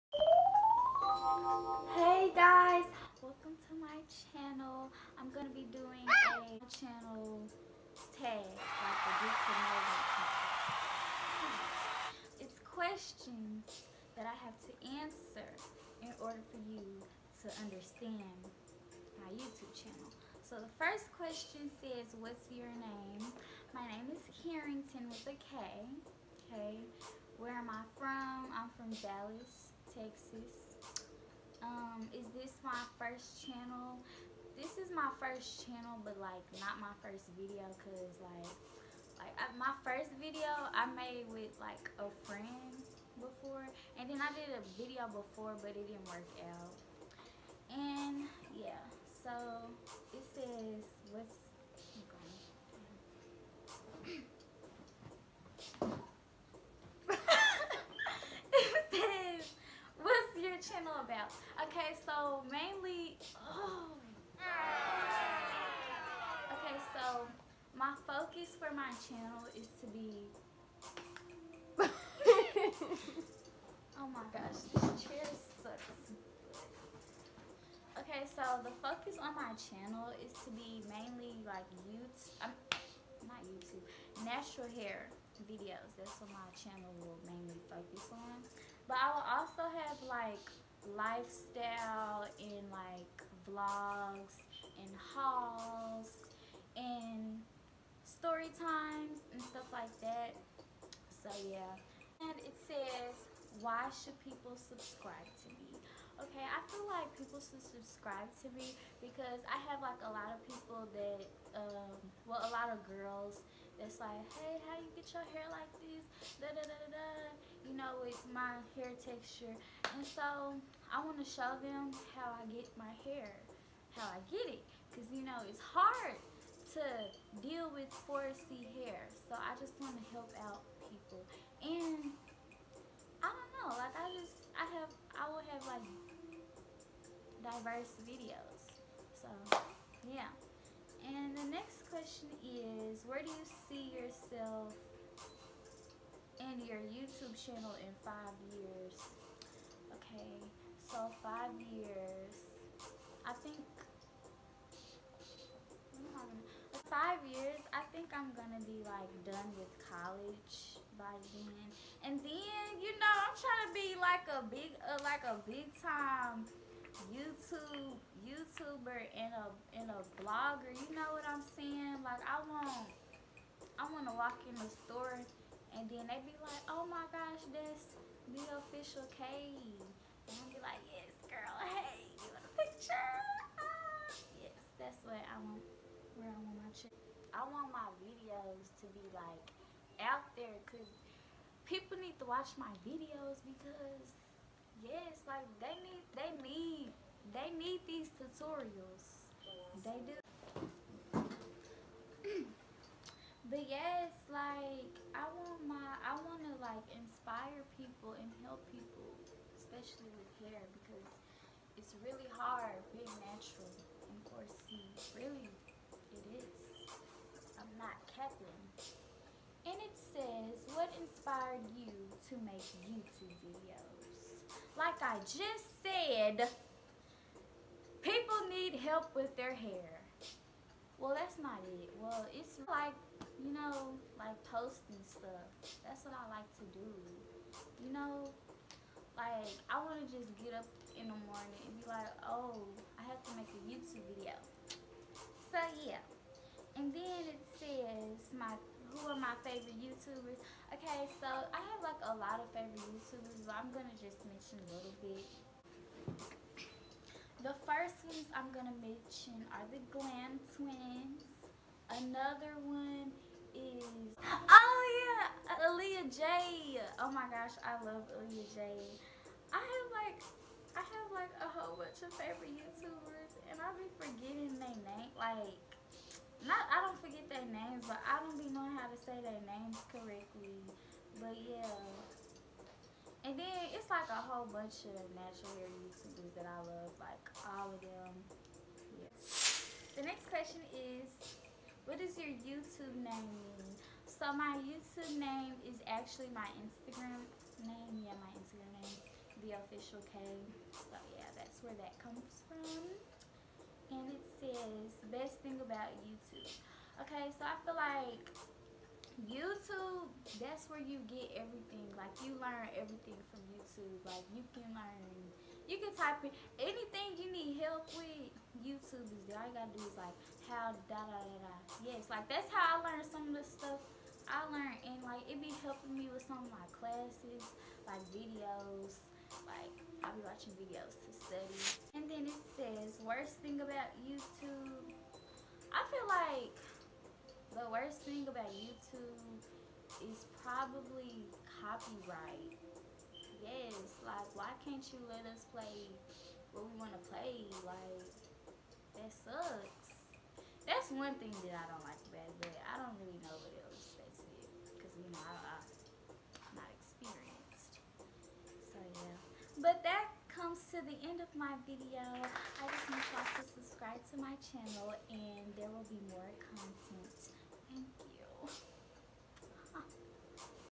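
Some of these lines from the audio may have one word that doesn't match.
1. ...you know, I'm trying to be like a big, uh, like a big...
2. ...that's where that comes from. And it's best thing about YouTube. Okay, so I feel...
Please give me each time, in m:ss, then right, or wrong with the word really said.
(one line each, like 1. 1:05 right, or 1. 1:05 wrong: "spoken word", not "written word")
1. 2:42 right
2. 5:01 right.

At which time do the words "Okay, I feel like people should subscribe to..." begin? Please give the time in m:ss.
1:46.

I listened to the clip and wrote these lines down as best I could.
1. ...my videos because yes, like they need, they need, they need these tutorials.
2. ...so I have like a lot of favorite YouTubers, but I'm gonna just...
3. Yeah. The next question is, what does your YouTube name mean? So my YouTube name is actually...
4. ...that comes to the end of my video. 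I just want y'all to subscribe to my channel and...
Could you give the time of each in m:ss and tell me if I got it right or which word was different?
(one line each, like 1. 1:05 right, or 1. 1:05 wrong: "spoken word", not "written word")
1. 3:12 right
2. 4:11 right
3. 4:48 right
4. 5:59 right.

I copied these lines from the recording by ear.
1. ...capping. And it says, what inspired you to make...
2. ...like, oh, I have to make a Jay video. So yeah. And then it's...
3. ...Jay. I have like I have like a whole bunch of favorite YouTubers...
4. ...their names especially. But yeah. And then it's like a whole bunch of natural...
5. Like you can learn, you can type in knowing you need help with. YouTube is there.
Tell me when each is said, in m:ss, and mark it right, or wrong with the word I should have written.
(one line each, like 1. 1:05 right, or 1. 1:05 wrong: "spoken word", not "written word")
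1. 3:38 right
2. 4:01 wrong: "YouTube", not "Jay"
3. 4:28 right
4. 4:39 wrong: "correctly", not "especially"
5. 5:14 wrong: "anything", not "knowing".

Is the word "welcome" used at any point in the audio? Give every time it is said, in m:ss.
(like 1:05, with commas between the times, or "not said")
0:03.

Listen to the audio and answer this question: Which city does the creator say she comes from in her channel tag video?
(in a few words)
Dallas, Texas.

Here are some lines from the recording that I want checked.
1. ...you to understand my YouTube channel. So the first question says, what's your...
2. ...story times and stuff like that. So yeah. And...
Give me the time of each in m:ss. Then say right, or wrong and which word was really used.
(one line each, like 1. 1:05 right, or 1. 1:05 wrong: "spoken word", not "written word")
1. 0:16 right
2. 1:38 right.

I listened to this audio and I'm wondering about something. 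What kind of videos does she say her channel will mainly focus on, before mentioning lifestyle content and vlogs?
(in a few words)
Natural hair videos.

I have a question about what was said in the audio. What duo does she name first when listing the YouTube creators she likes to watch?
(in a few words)
The Glam Twins.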